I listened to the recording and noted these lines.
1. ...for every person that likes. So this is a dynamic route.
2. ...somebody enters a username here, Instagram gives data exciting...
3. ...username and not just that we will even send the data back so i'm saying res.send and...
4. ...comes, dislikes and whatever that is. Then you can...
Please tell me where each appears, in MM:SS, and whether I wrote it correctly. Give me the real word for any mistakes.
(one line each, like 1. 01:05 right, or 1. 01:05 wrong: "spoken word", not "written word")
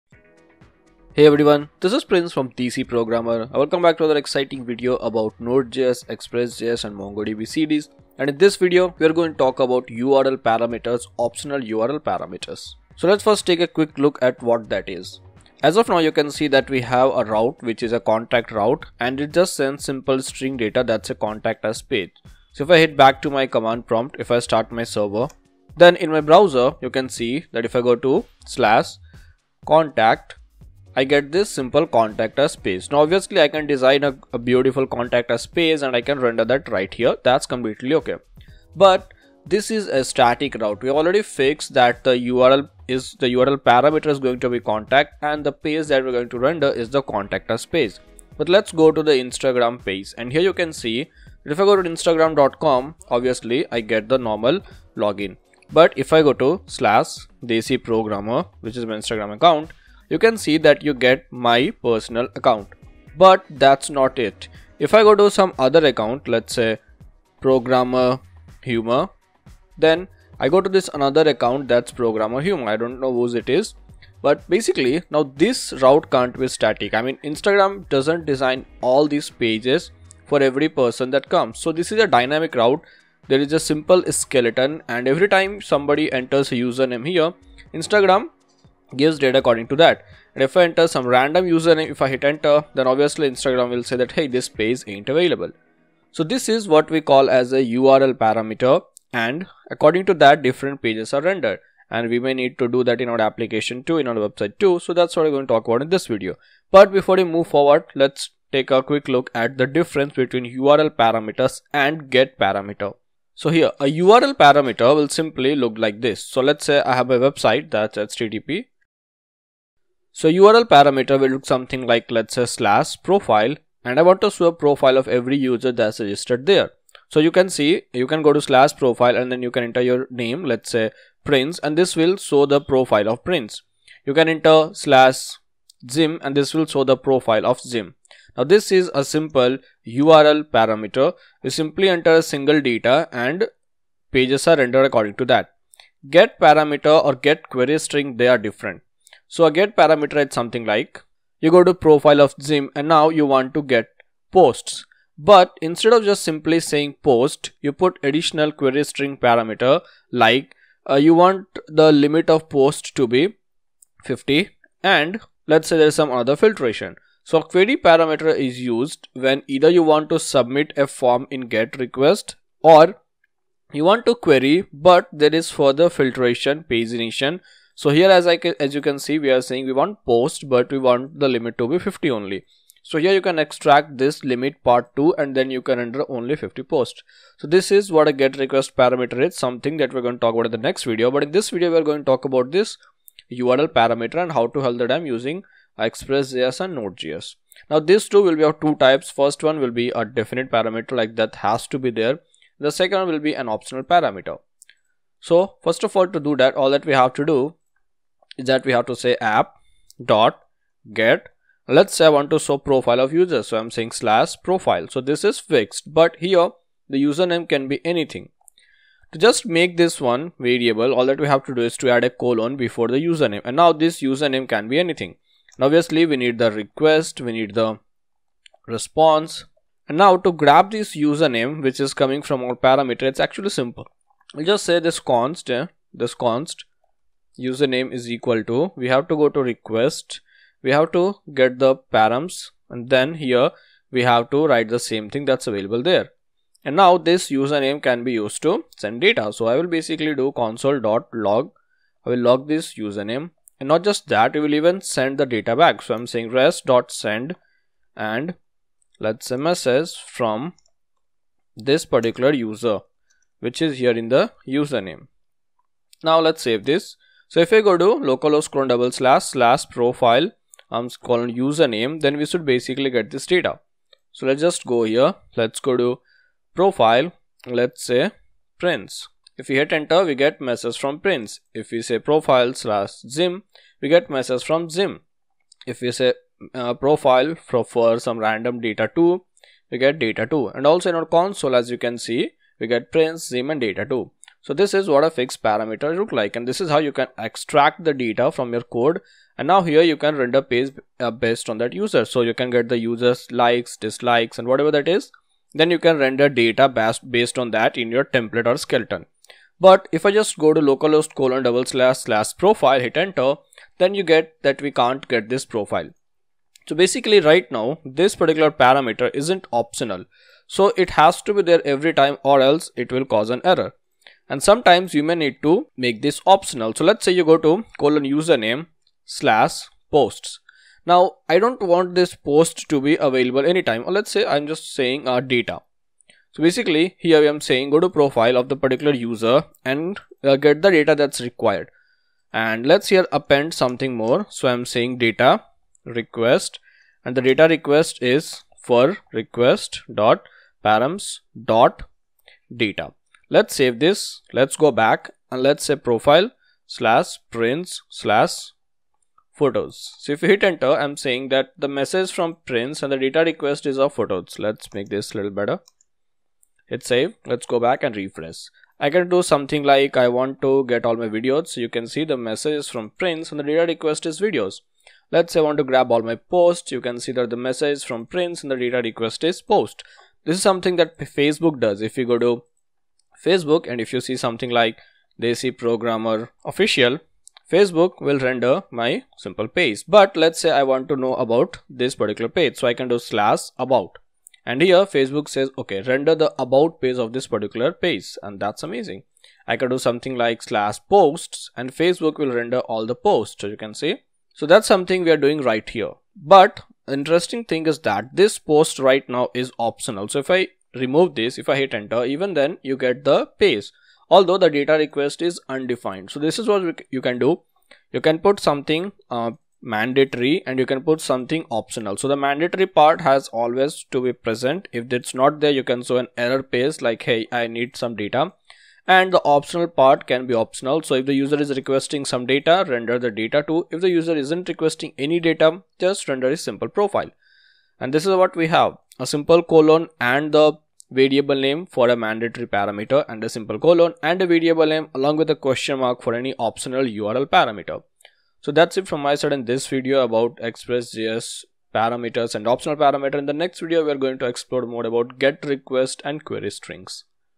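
1. 01:20 wrong: "comes", not "likes"
2. 01:25 wrong: "according", not "exciting"
3. 04:12 right
4. 05:03 wrong: "likes", not "comes".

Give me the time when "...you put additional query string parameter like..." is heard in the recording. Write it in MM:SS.
02:37.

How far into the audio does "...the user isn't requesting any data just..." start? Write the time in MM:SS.
07:13.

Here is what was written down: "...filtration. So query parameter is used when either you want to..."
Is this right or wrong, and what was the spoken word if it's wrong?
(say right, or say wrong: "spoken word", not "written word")
right.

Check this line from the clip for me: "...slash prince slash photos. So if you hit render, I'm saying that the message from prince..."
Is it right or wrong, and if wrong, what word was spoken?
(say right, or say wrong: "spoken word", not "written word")
wrong: "enter", not "render".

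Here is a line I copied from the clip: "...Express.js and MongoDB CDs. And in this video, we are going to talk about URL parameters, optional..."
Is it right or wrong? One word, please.
right.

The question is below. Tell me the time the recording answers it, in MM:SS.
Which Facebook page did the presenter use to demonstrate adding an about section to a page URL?
06:25.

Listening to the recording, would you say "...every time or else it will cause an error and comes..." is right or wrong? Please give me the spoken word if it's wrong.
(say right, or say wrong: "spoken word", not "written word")
wrong: "sometimes", not "comes".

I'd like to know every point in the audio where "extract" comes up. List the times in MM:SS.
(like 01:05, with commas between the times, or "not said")
03:03, 04:57.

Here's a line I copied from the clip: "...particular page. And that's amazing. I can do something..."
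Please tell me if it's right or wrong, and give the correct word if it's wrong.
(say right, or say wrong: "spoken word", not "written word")
right.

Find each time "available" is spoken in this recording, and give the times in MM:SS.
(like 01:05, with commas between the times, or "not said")
01:35, 04:05, 05:32.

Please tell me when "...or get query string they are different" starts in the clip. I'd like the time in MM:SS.
02:27.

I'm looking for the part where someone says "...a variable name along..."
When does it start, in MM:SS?
07:24.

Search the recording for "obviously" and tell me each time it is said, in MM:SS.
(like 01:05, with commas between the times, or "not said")
00:33, 00:53, 01:32, 03:45.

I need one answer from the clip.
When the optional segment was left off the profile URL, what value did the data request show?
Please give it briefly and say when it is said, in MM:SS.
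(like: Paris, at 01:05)
undefined, at 06:55.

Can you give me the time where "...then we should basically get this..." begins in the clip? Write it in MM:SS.
04:32.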